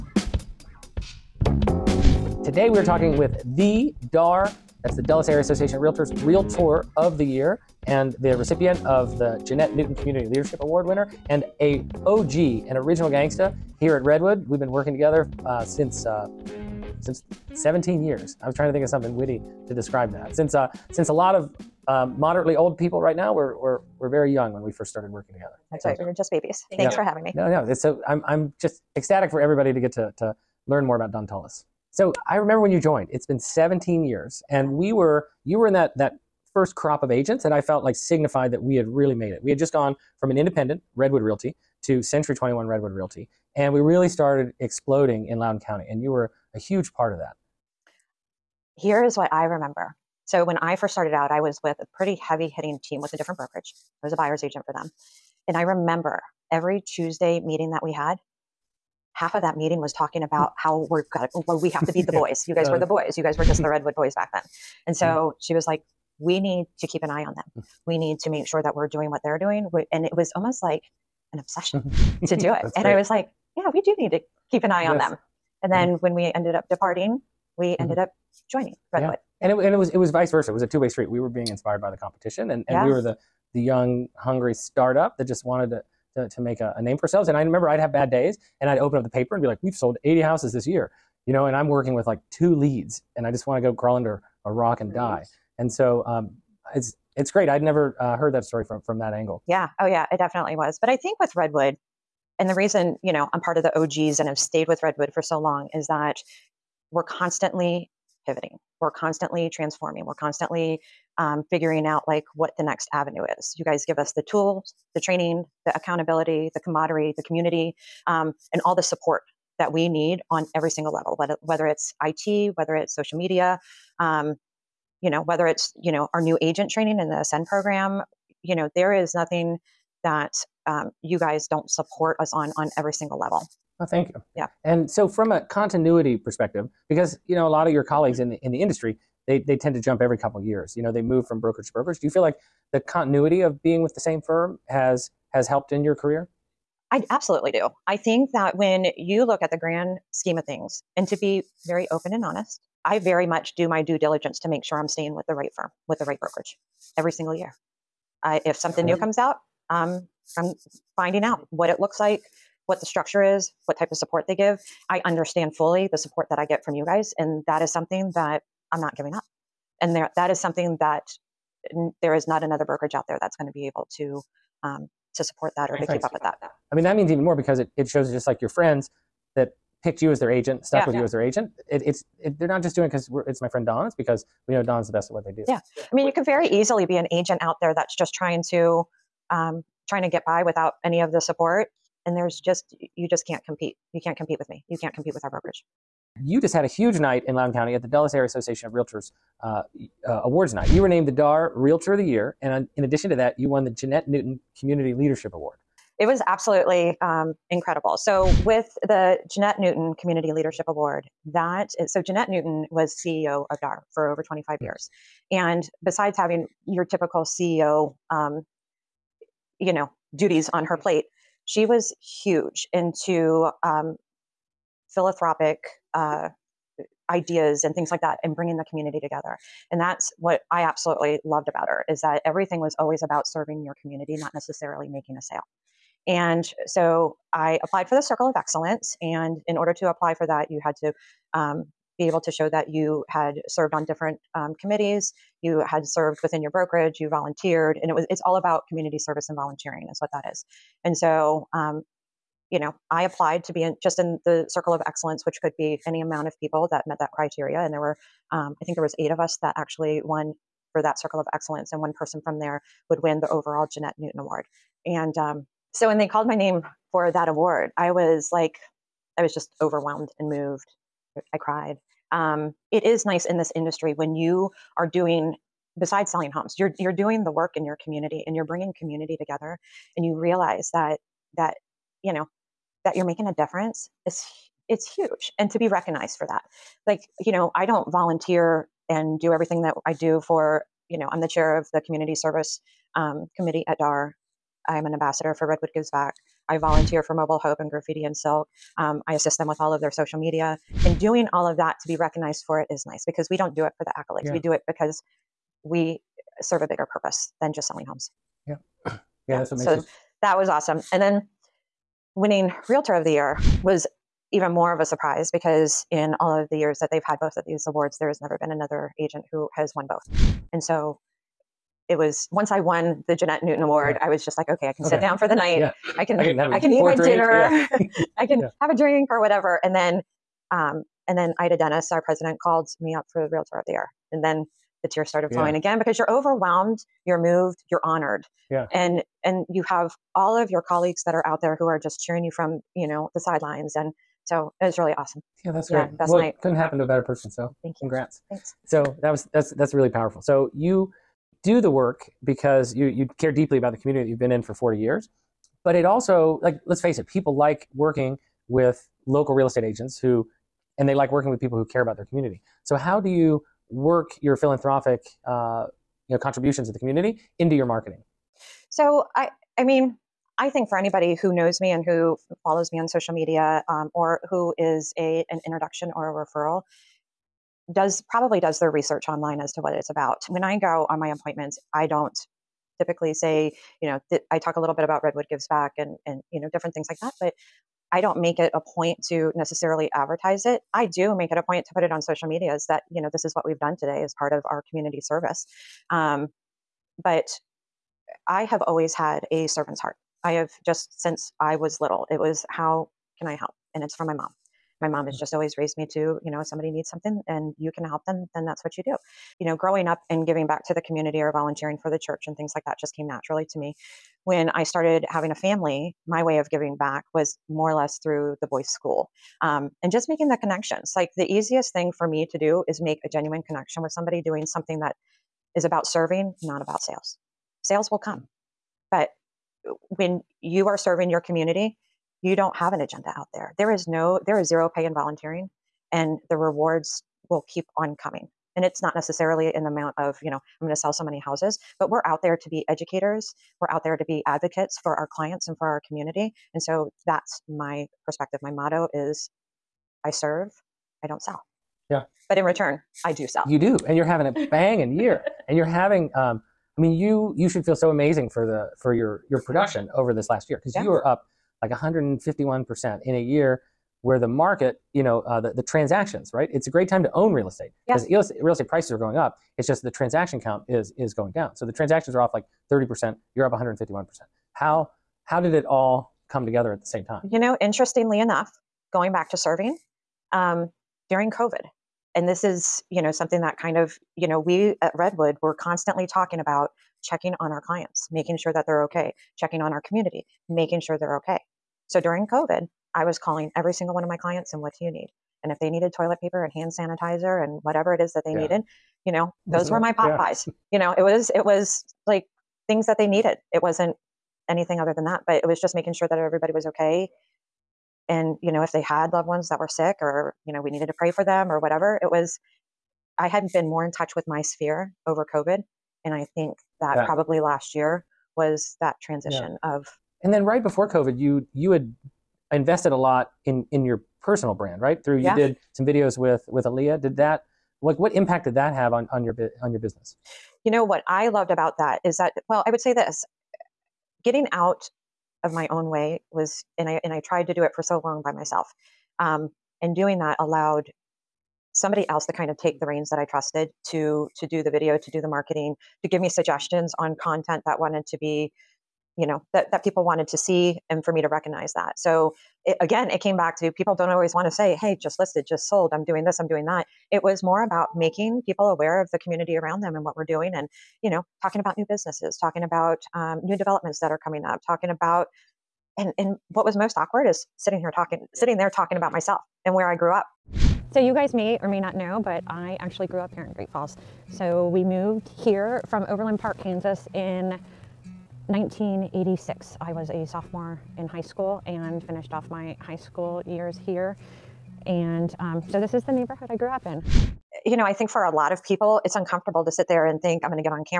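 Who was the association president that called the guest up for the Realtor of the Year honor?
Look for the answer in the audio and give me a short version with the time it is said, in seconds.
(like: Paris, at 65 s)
Ida Dennis, at 331 s.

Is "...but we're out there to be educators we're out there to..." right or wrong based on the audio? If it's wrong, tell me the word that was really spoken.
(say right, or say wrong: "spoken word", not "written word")
right.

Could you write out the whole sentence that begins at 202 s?
And on, in addition to that, you won the Jeanette Newton Community Leadership Award.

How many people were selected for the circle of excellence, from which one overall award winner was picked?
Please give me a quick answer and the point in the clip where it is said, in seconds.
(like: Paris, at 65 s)
8, at 258 s.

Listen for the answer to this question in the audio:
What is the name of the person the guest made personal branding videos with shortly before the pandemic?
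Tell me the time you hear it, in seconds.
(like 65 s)
526 s.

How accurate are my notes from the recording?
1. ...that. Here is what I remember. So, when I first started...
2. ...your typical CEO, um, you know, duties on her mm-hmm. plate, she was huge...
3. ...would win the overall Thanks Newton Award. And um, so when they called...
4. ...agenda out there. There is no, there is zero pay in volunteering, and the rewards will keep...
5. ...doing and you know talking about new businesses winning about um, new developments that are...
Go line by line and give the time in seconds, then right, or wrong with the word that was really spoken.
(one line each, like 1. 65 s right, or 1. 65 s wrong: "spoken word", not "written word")
1. 47 s right
2. 216 s right
3. 262 s wrong: "Jeanette", not "Thanks"
4. 432 s right
5. 560 s wrong: "talking", not "winning".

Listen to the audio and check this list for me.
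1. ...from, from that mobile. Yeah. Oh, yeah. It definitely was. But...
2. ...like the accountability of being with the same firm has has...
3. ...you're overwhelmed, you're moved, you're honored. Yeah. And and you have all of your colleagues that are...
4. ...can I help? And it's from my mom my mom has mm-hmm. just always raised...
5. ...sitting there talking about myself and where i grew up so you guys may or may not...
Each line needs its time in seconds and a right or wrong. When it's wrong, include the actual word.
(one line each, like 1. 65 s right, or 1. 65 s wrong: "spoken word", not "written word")
1. 98 s wrong: "angle", not "mobile"
2. 142 s wrong: "continuity", not "accountability"
3. 335 s right
4. 403 s right
5. 568 s right.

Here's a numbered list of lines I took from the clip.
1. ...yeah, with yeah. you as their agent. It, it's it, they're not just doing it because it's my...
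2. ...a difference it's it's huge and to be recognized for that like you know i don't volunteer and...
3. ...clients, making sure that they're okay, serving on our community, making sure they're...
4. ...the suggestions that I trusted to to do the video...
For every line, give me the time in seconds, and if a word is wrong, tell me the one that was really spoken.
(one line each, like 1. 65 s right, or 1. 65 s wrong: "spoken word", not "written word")
1. 180 s right
2. 283 s right
3. 487 s wrong: "checking", not "serving"
4. 542 s wrong: "reins", not "suggestions".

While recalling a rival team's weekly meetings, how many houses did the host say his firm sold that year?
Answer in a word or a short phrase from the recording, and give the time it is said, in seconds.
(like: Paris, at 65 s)
80, at 90 s.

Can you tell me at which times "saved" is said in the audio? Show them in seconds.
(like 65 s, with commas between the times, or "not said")
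not said.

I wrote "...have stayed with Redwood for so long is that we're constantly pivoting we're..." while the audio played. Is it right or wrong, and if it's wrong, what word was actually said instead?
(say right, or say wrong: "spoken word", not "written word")
right.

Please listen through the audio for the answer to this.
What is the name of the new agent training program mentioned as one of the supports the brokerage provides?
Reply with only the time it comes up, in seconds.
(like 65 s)
127 s.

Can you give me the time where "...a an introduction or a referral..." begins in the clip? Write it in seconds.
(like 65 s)
374 s.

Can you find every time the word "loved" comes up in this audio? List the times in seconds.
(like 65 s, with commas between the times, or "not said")
231 s, 509 s, 531 s.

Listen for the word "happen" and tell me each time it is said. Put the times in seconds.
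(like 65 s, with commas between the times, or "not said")
346 s.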